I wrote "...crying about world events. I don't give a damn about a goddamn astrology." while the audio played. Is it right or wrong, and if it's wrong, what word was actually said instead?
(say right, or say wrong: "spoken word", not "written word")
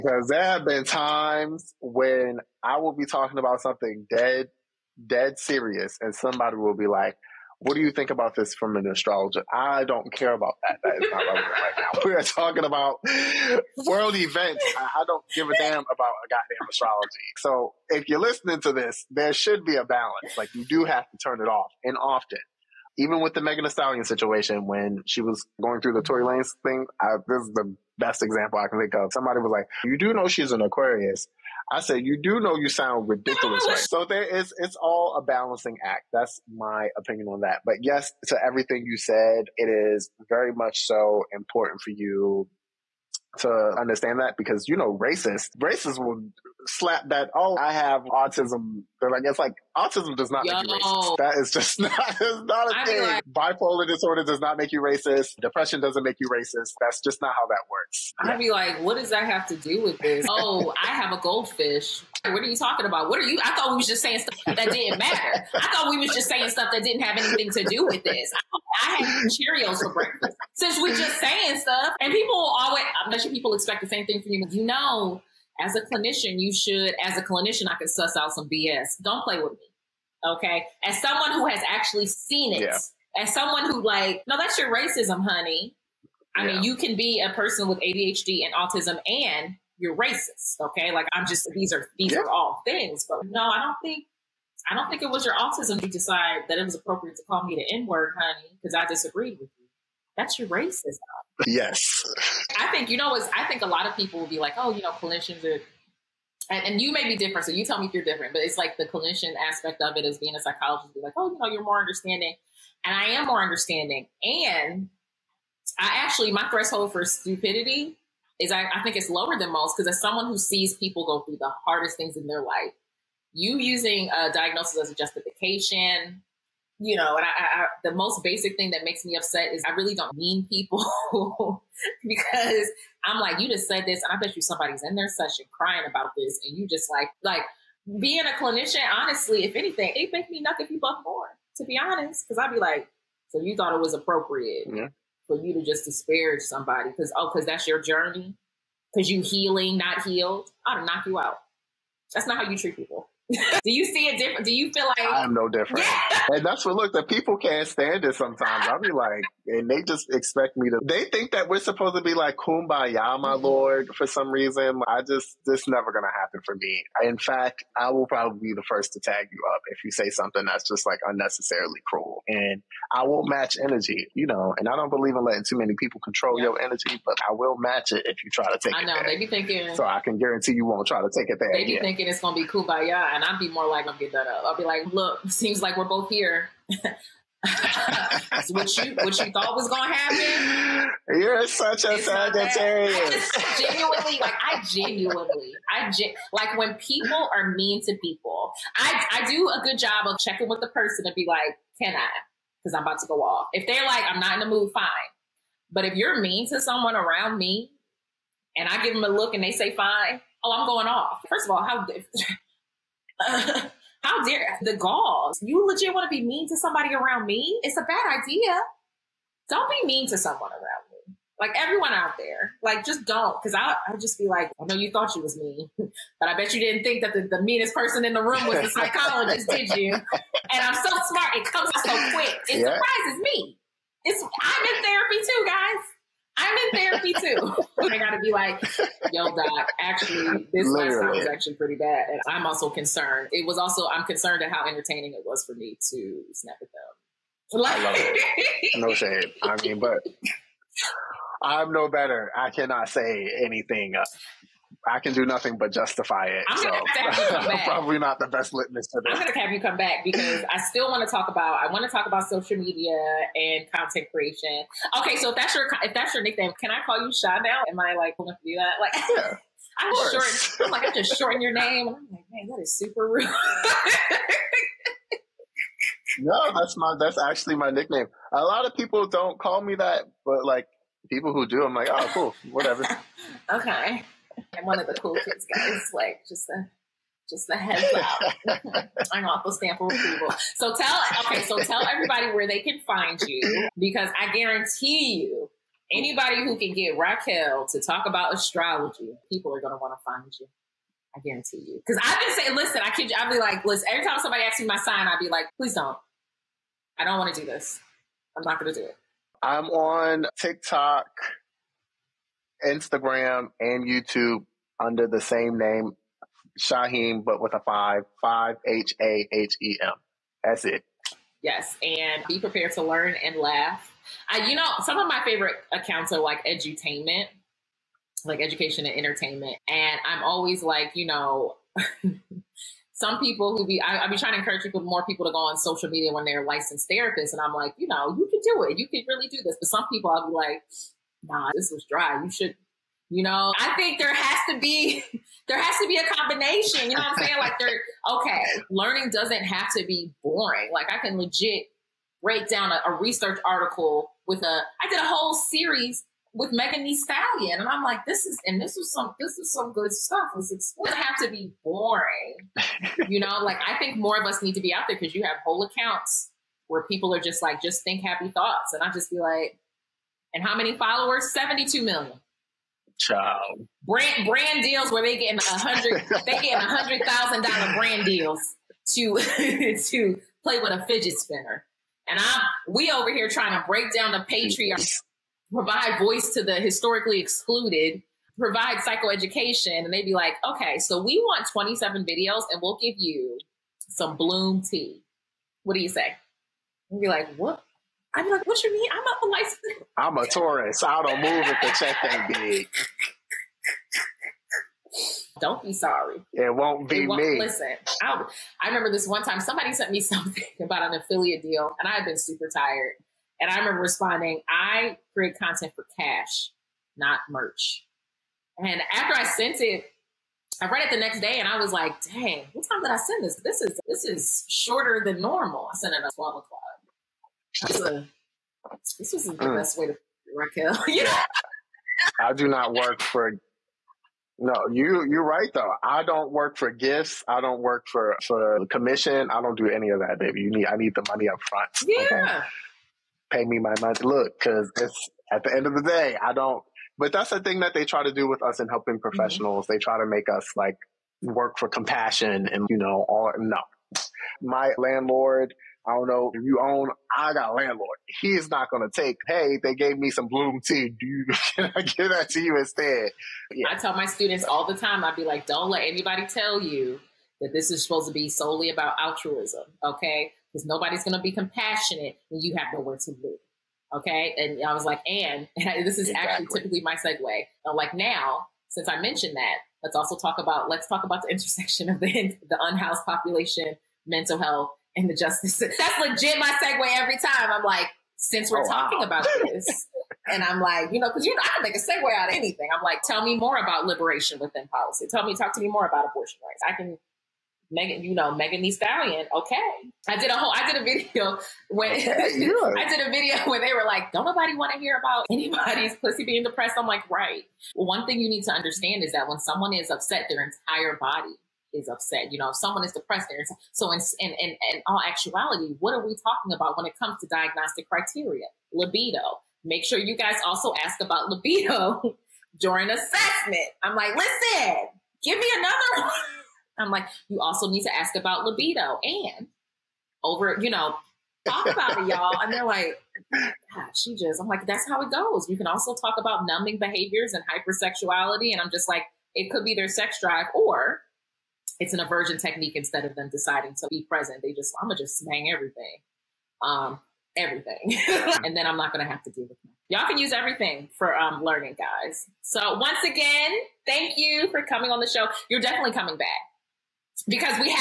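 wrong: "talking", not "crying".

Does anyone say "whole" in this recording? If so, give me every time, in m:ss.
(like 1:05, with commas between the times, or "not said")
5:55, 6:05, 8:20.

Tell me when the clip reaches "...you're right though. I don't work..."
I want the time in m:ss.
7:15.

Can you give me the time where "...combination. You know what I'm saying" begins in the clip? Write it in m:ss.
5:46.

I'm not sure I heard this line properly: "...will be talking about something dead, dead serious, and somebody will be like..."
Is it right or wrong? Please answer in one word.
right.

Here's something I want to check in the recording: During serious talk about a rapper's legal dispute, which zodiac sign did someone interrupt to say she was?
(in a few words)
Aquarius.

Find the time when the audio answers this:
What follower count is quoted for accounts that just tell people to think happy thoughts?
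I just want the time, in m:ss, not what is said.
6:11.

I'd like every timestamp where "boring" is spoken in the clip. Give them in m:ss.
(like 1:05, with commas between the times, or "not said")
5:50, 6:01.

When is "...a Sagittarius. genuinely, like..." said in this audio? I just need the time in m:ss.
3:11.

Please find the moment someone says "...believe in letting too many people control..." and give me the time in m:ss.
2:54.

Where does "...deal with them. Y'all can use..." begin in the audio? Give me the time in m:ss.
9:09.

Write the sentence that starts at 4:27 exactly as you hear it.
Am I like willing to do that?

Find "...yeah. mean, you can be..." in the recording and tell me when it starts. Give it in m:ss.
1:26.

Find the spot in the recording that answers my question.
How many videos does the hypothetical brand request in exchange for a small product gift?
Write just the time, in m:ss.
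6:31.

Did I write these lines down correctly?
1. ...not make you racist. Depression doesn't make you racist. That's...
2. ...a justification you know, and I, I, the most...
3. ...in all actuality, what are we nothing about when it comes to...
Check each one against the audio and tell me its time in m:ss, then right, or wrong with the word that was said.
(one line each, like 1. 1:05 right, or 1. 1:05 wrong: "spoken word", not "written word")
1. 0:54 right
2. 2:04 right
3. 8:34 wrong: "talking", not "nothing".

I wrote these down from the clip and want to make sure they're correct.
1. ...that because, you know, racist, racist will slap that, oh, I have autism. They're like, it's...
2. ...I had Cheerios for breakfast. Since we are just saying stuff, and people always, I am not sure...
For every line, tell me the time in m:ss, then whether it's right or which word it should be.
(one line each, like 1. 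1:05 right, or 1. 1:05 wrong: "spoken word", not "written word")
1. 0:44 right
2. 1:08 right.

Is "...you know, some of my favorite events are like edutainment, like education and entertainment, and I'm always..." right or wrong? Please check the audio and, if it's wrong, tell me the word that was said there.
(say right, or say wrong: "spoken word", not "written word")
wrong: "accounts", not "events".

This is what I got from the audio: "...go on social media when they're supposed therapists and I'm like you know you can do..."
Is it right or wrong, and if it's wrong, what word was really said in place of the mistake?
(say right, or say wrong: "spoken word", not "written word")
wrong: "licensed", not "supposed".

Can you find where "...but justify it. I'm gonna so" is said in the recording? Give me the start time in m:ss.
4:15.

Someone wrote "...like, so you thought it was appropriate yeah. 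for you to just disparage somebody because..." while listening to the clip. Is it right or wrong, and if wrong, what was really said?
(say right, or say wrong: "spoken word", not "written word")
right.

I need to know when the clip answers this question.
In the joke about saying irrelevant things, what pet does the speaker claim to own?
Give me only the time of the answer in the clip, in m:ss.
1:00.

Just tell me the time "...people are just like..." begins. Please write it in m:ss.
6:06.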